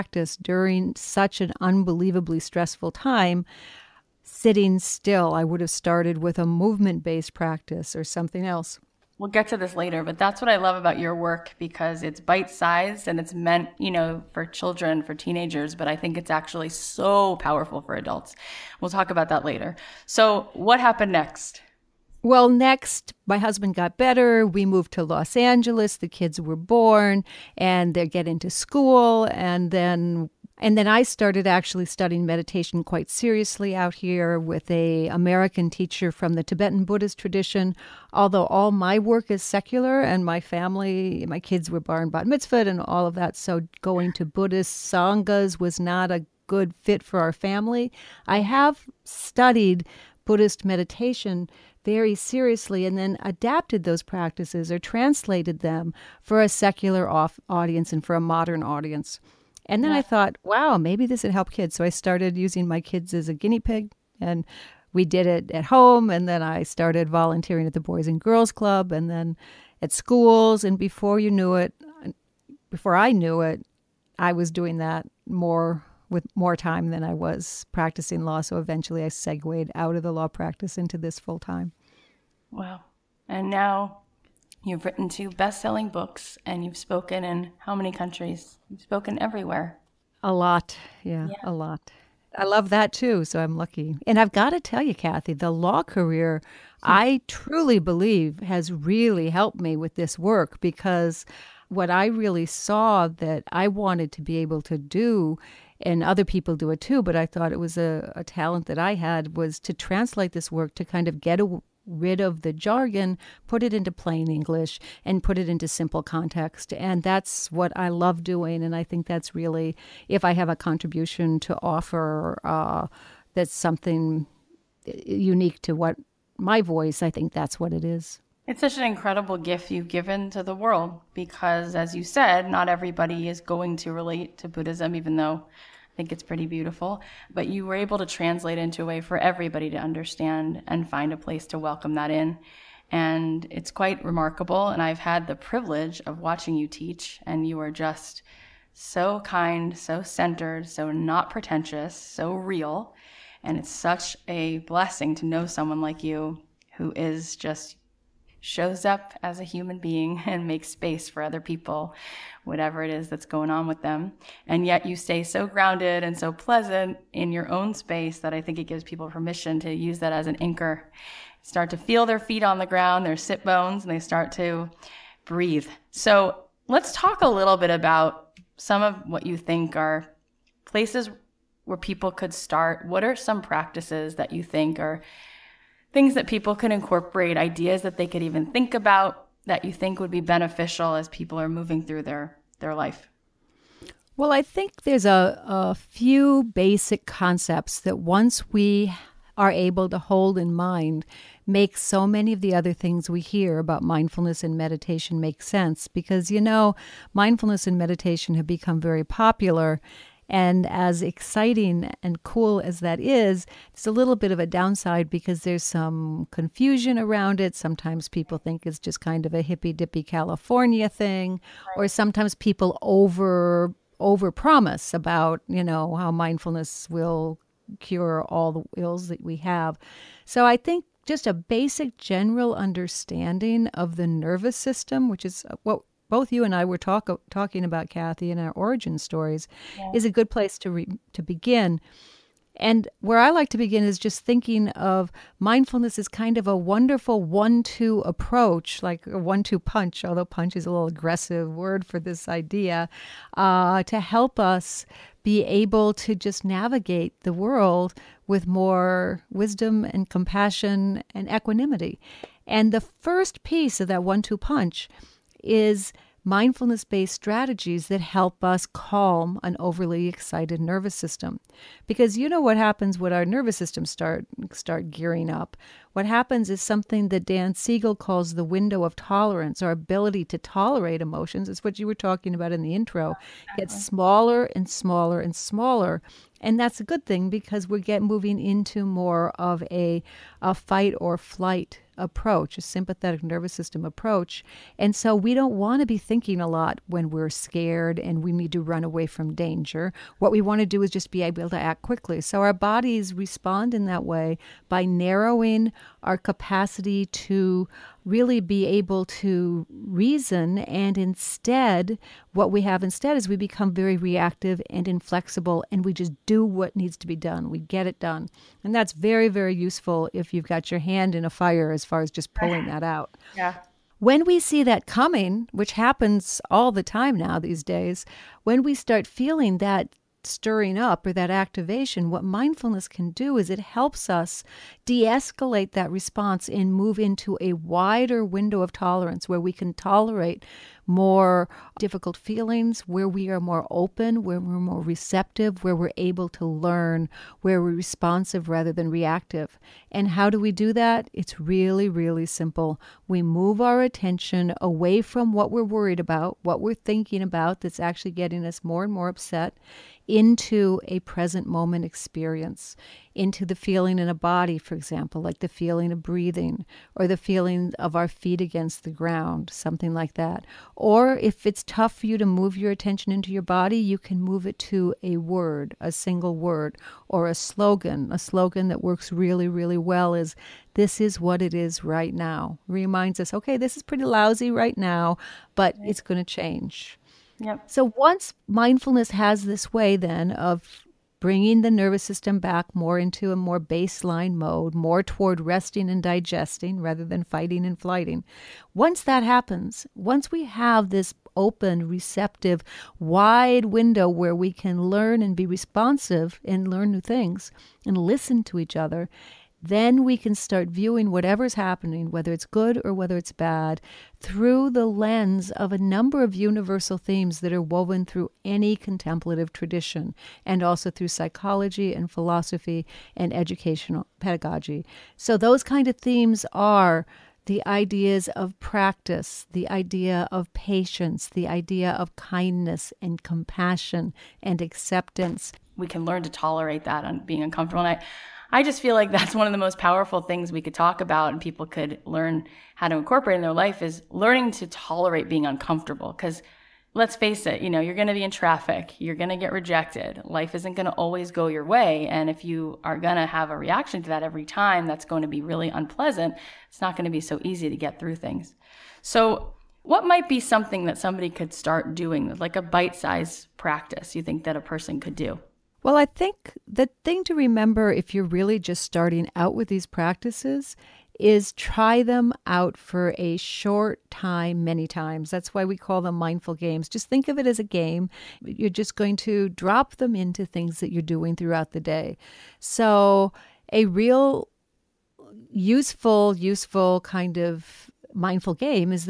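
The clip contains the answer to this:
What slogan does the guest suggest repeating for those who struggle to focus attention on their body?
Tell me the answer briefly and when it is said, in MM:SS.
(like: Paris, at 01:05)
This is what it is right now, at 06:20.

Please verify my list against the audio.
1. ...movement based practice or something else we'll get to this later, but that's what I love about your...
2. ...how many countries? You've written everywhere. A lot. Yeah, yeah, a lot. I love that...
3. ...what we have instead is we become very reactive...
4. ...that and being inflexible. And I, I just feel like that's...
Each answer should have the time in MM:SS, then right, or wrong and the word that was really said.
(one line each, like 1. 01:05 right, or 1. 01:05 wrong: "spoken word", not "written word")
1. 00:06 right
2. 01:27 wrong: "spoken", not "written"
3. 05:12 right
4. 07:16 wrong: "uncomfortable", not "inflexible".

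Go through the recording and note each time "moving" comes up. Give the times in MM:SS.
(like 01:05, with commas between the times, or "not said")
03:11, 04:48.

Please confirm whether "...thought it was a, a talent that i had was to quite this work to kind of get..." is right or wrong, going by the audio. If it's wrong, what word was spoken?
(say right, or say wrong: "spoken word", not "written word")
wrong: "translate", not "quite".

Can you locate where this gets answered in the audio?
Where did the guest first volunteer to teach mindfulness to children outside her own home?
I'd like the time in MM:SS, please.
01:07.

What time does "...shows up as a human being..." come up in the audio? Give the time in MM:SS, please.
02:38.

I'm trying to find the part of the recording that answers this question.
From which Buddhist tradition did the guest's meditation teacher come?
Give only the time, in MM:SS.
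00:36.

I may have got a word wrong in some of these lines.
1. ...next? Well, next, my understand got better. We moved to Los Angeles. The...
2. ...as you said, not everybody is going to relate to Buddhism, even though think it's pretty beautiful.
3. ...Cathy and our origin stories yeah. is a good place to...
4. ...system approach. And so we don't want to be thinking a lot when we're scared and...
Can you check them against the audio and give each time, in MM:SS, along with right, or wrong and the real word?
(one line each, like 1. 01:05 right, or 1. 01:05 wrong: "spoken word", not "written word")
1. 00:21 wrong: "husband", not "understand"
2. 02:11 right
3. 03:57 right
4. 04:53 right.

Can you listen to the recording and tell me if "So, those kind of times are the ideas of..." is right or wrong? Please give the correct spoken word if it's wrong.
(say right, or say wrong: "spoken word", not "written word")
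wrong: "themes", not "times".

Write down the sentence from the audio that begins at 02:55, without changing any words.
So let's talk a little bit about some of what you think are places where people could start.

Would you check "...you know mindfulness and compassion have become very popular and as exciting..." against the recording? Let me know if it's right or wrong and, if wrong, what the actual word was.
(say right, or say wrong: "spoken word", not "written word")
wrong: "meditation", not "compassion".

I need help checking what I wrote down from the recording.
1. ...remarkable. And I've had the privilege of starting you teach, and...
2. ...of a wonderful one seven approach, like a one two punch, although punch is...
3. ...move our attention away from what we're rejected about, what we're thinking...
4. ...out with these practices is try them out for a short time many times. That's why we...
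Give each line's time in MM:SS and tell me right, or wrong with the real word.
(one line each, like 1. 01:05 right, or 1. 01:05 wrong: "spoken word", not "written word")
1. 02:24 wrong: "watching", not "starting"
2. 04:06 wrong: "two", not "seven"
3. 05:53 wrong: "worried", not "rejected"
4. 07:49 right.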